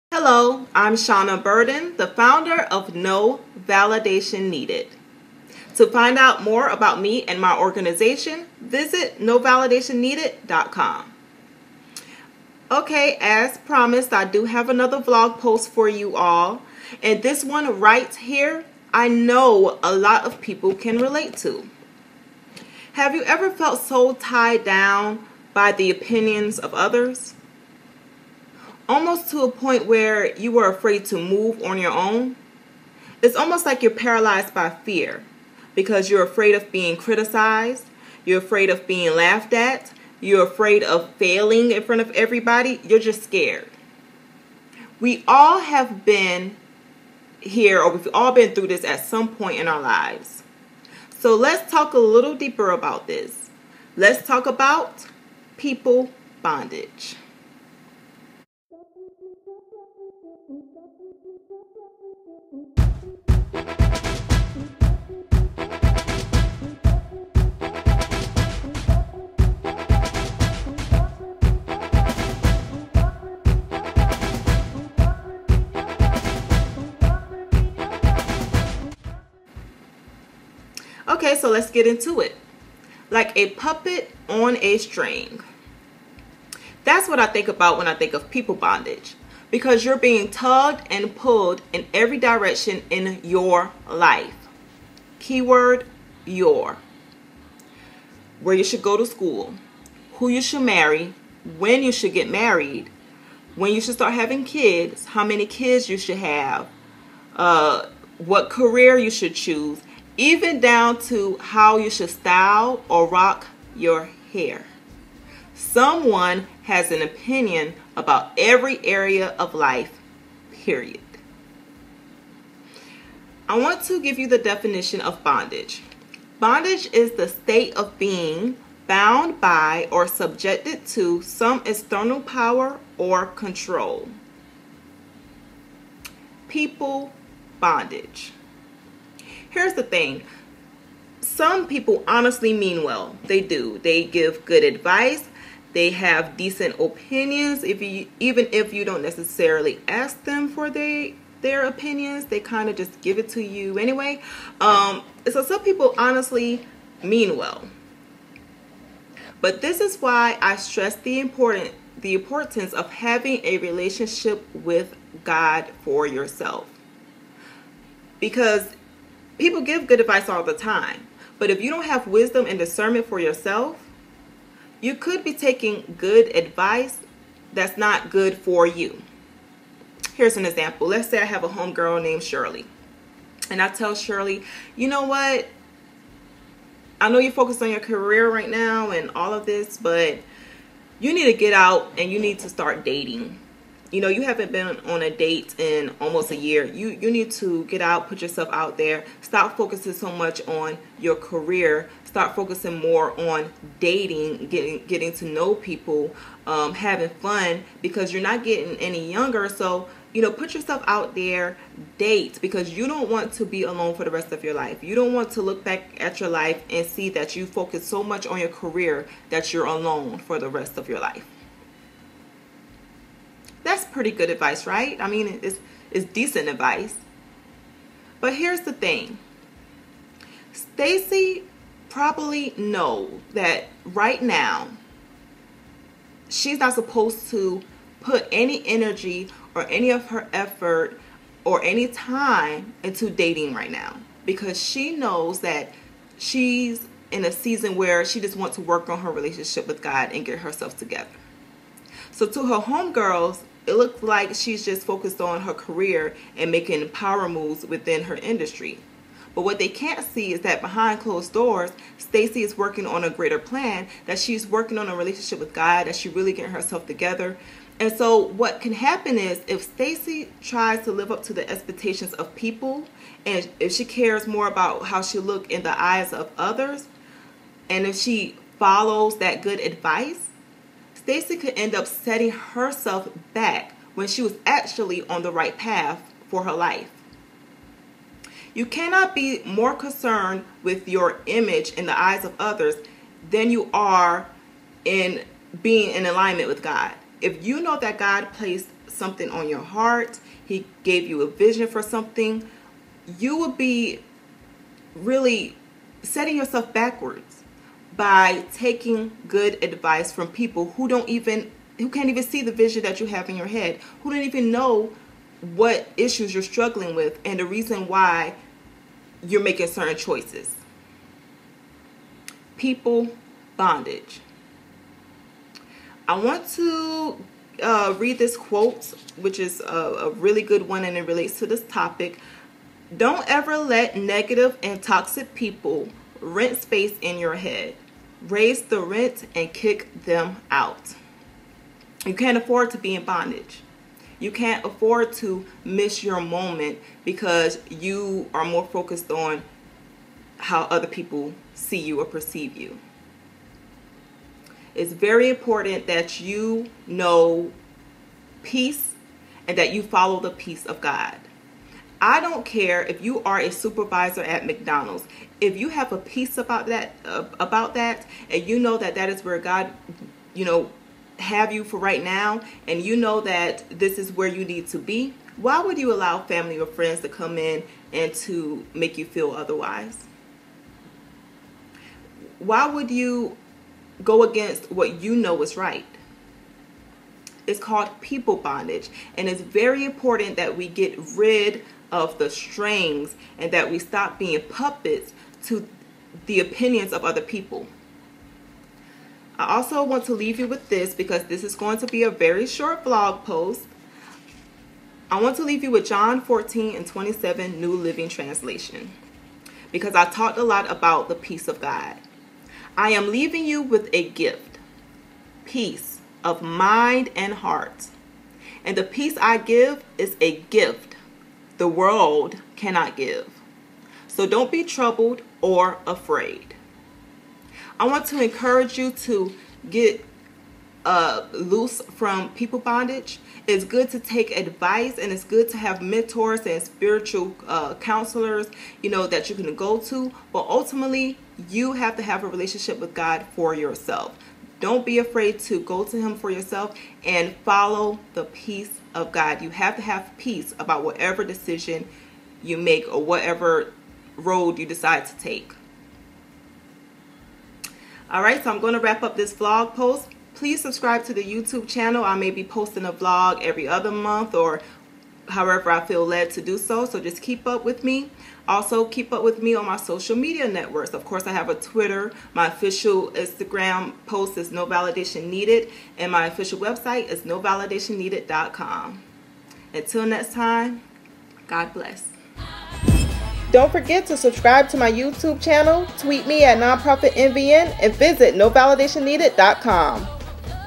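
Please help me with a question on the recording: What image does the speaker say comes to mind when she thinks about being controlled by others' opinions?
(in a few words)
A puppet on a string.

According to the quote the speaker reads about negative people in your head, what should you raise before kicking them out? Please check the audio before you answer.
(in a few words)
The rent.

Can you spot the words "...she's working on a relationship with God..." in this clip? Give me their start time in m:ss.
4:24.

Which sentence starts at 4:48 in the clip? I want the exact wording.
You cannot be more concerned with your image in the eyes of others than you are in being in alignment with God.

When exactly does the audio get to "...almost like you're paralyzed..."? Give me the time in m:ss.
0:33.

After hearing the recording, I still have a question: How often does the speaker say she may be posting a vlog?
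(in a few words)
Every other month.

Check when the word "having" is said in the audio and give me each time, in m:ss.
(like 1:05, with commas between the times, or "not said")
1:44, 2:42, 3:26.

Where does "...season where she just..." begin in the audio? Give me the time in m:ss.
4:07.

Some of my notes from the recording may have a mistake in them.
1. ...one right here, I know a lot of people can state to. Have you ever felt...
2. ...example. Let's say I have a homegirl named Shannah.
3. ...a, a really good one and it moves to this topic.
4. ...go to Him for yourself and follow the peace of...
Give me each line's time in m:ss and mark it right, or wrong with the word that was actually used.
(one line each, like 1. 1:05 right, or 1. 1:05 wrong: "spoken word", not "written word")
1. 0:17 wrong: "relate", not "state"
2. 3:00 wrong: "Shirley", not "Shannah"
3. 5:29 wrong: "relates", not "moves"
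4. 7:25 right.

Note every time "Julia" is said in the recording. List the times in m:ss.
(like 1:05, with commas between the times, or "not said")
not said.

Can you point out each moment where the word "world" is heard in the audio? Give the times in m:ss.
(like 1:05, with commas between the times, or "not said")
7:01.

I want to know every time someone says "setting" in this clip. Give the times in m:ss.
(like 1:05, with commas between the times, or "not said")
4:41, 5:06.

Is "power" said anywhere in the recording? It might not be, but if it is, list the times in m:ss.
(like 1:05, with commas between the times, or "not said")
2:12, 4:16.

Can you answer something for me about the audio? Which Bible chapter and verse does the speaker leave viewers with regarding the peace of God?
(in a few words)
John 14:27.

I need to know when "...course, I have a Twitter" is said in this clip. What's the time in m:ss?
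7:51.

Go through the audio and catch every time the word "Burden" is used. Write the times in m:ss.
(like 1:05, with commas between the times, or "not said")
0:01.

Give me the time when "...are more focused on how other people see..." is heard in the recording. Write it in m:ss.
5:48.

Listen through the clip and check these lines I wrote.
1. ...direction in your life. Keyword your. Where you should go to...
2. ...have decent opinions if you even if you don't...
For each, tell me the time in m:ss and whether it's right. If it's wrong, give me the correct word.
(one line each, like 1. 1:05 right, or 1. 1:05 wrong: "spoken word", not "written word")
1. 1:32 right
2. 2:25 right.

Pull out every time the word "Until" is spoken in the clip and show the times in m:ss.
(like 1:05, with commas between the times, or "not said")
7:59.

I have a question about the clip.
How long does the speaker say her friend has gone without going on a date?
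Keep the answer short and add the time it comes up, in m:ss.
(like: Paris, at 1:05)
Almost a year, at 3:15.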